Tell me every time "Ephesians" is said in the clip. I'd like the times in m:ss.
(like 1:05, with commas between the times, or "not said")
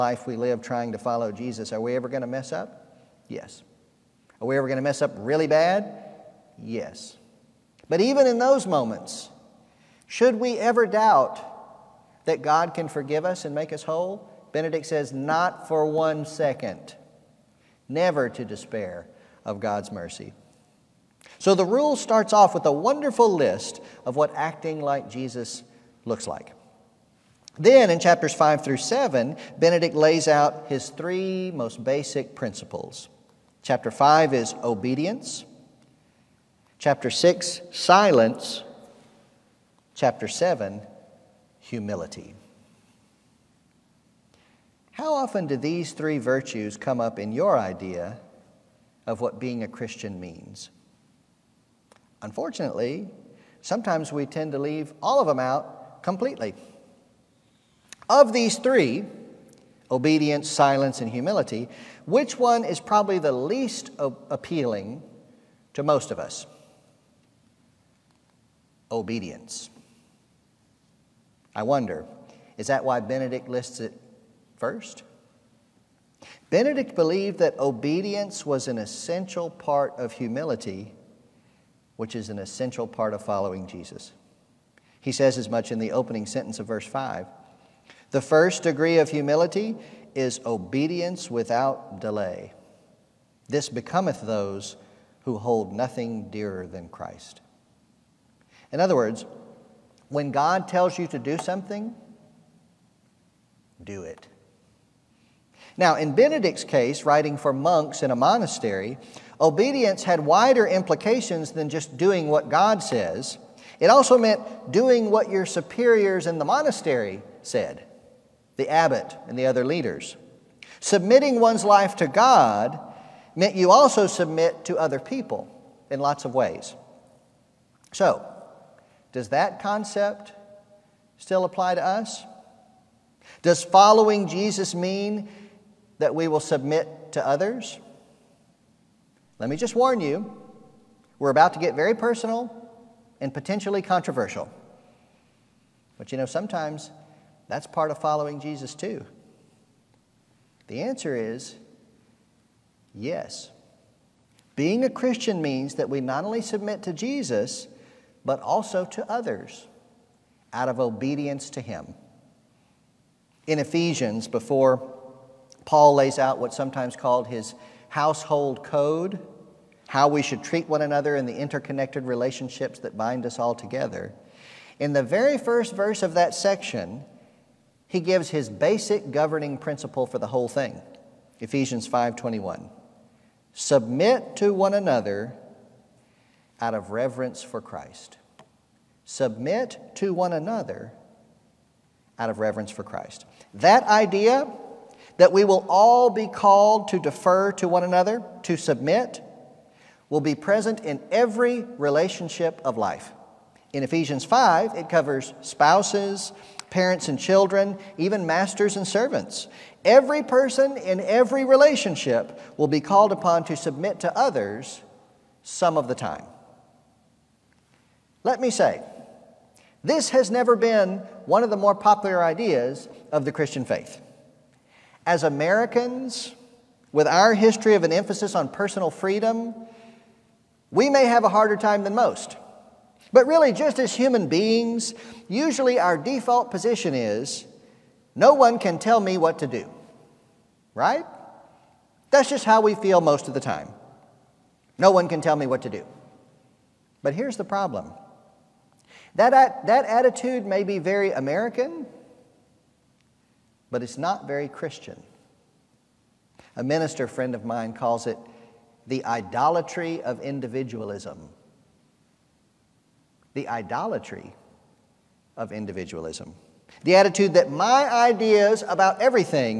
2:43, 3:01, 3:23.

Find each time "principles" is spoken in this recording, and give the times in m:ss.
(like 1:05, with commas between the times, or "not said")
0:32, 2:59.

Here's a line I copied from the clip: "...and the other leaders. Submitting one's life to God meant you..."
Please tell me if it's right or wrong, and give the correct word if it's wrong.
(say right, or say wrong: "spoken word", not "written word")
right.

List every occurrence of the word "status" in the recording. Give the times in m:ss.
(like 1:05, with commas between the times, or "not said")
not said.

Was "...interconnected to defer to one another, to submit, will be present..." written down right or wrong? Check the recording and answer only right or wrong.
wrong.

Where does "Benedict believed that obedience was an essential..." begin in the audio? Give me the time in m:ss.
1:16.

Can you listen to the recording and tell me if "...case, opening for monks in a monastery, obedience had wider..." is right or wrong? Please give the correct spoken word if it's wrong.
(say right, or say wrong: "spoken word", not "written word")
wrong: "writing", not "opening".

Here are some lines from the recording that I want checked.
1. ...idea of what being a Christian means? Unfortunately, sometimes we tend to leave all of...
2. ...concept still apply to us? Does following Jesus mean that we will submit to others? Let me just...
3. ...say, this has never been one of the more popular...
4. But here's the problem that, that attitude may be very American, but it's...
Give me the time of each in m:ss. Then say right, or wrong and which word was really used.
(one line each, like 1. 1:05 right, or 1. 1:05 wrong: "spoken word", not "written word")
1. 0:47 right
2. 2:09 right
3. 3:38 right
4. 4:07 right.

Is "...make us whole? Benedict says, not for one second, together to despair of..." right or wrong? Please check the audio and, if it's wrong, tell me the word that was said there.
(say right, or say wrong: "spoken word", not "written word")
wrong: "never", not "together".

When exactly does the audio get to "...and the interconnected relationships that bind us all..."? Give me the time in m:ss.
2:51.